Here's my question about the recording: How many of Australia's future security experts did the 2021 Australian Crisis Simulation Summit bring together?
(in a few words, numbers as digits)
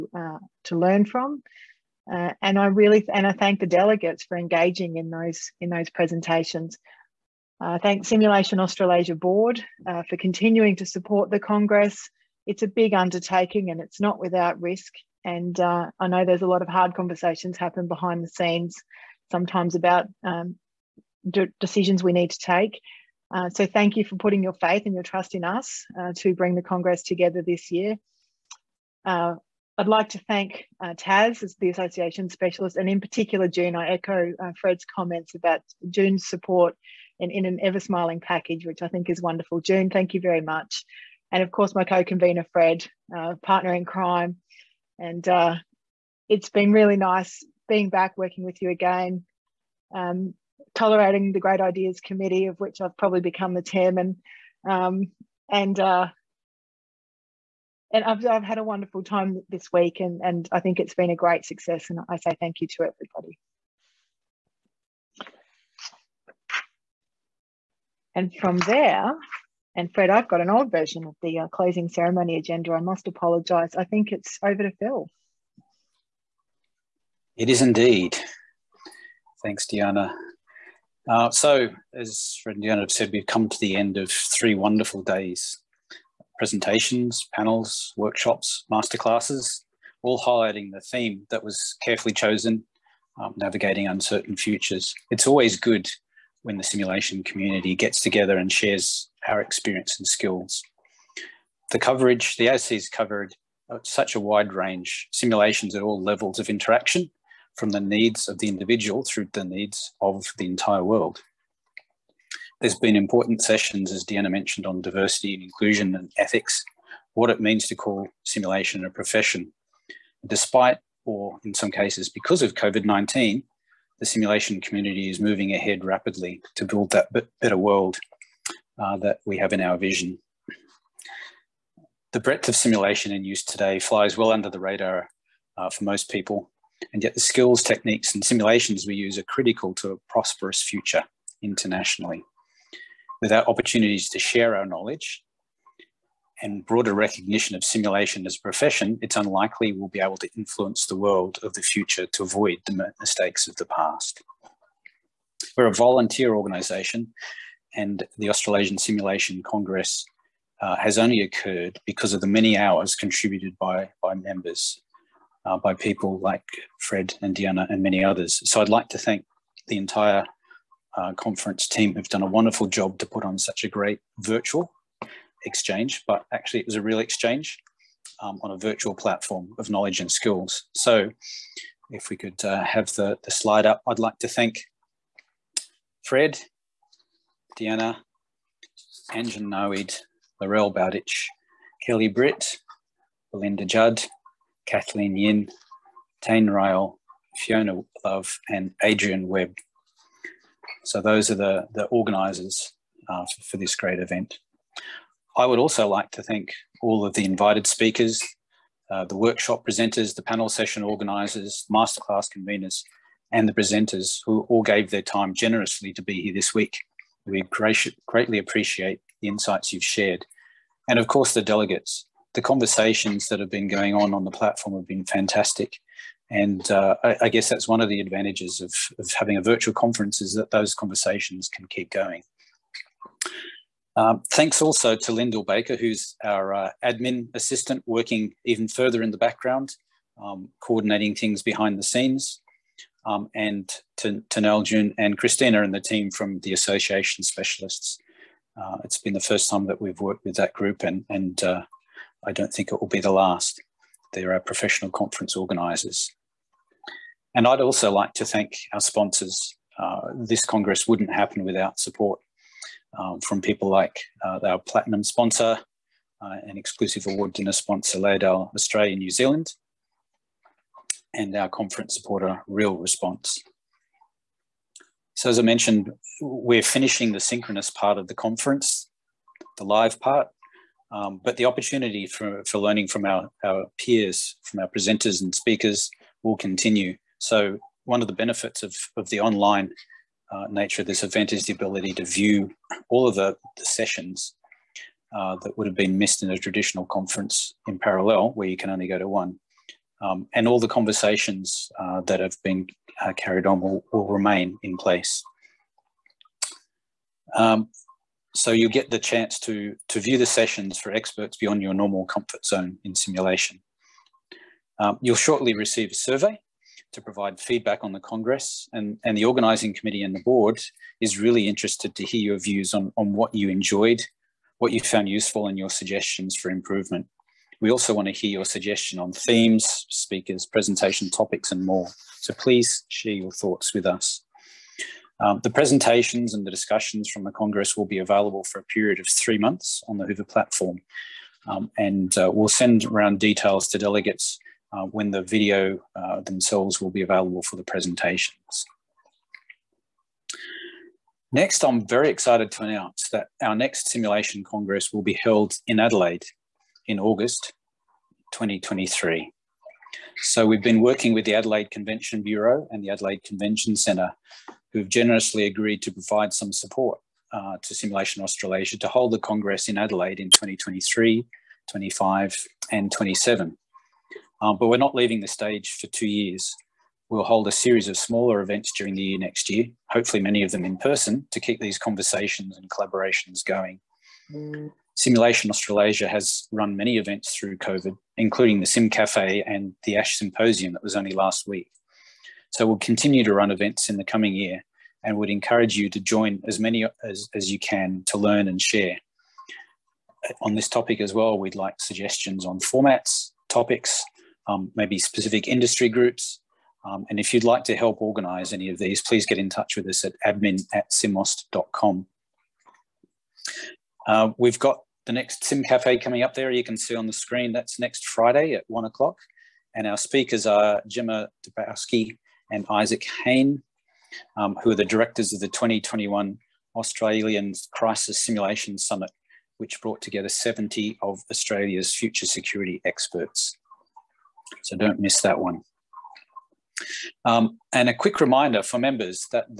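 70.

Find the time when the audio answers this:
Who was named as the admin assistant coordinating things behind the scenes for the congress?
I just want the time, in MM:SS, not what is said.
03:55.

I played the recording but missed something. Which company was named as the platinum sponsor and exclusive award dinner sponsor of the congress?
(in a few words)
Laerdal Australia New Zealand.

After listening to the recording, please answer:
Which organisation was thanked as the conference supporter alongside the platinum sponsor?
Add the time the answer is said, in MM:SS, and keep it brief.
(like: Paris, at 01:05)
Real Response, at 04:32.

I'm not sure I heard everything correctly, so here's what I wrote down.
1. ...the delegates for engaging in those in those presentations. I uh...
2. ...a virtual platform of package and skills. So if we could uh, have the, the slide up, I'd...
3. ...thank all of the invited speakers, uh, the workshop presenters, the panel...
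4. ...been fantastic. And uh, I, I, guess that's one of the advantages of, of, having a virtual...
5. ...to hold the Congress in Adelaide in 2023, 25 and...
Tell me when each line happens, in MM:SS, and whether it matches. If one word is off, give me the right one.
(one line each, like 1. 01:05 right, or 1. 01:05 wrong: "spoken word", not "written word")
1. 00:03 right
2. 02:58 wrong: "knowledge", not "package"
3. 03:26 right
4. 03:44 right
5. 06:08 right.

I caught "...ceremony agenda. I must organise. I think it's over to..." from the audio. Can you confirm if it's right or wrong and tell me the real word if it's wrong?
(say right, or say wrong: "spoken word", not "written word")
wrong: "apologise", not "organise".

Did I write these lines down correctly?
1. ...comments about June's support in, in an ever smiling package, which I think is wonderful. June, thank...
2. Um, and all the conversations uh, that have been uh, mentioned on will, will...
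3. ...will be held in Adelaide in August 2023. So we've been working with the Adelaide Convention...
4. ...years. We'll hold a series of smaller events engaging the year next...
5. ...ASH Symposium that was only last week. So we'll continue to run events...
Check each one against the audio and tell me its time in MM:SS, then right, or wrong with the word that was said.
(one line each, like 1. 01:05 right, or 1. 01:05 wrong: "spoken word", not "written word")
1. 00:34 right
2. 05:00 wrong: "carried", not "mentioned"
3. 05:54 right
4. 06:16 wrong: "during", not "engaging"
5. 06:29 right.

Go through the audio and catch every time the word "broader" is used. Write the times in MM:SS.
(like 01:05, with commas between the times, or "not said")
02:26.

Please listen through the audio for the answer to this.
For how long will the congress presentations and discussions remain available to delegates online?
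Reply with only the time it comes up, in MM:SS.
05:39.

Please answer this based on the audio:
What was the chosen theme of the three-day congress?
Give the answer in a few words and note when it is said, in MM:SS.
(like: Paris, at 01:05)
Navigating uncertain futures, at 01:33.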